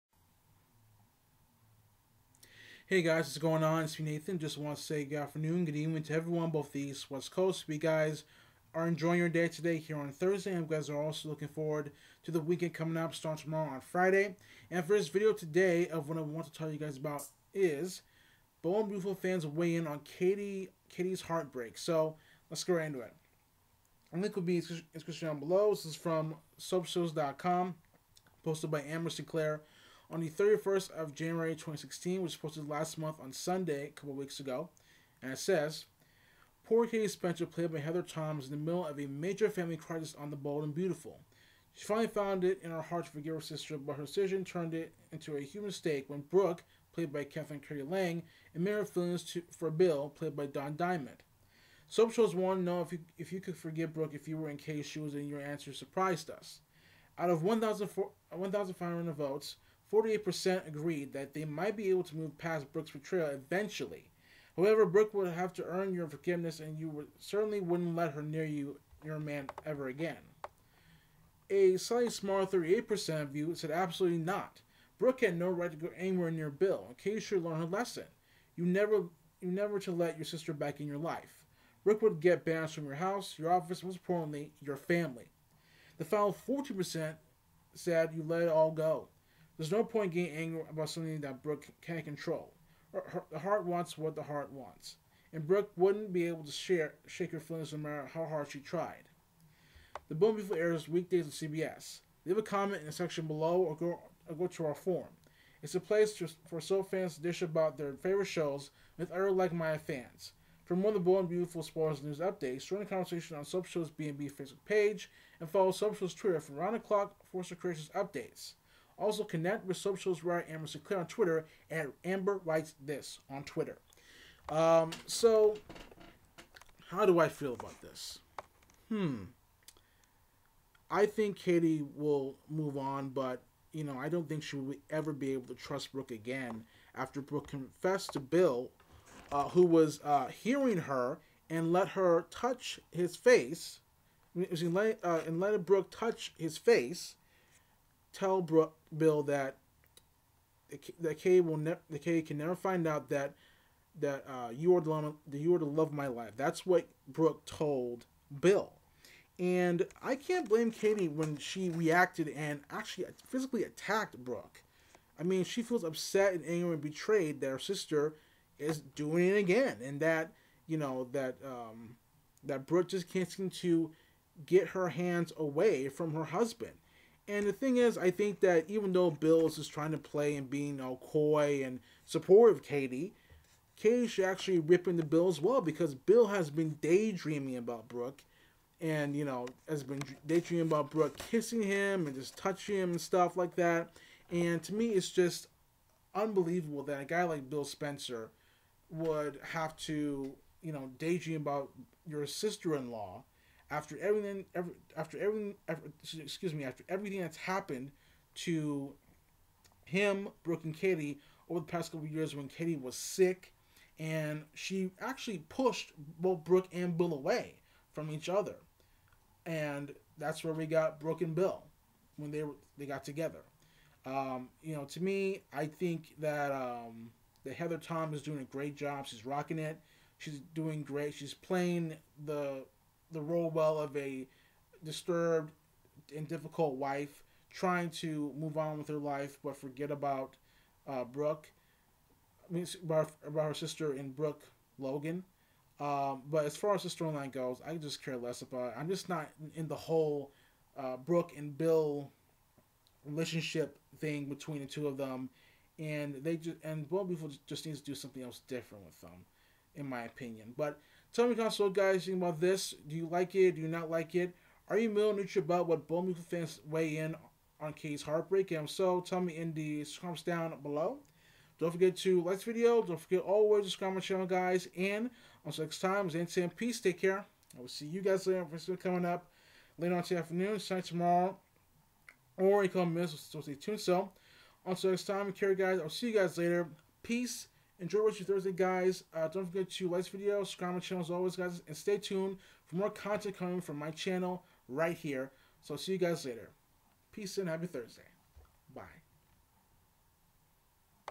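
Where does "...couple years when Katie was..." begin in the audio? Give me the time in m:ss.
3:31.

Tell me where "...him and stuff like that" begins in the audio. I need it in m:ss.
3:12.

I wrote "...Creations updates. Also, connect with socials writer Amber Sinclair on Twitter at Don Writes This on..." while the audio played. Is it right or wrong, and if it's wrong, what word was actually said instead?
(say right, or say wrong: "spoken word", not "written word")
wrong: "Amber", not "Don".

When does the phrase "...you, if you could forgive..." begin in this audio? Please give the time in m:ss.
0:52.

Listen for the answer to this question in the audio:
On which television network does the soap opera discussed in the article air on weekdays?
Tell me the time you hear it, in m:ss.
1:41.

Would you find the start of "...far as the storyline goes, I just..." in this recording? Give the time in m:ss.
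4:06.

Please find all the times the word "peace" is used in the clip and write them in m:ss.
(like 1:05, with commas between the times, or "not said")
4:36, 4:47, 4:57.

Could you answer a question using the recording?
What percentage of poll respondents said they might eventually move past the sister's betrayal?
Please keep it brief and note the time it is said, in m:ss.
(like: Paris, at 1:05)
48%, at 0:59.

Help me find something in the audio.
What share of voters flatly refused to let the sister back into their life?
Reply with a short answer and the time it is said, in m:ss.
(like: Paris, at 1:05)
38%, at 1:12.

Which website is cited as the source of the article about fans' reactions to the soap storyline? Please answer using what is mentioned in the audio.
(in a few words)
soapshows.com.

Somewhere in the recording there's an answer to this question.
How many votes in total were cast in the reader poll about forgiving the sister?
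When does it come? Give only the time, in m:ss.
0:57.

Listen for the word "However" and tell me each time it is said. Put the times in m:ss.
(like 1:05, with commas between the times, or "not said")
1:04.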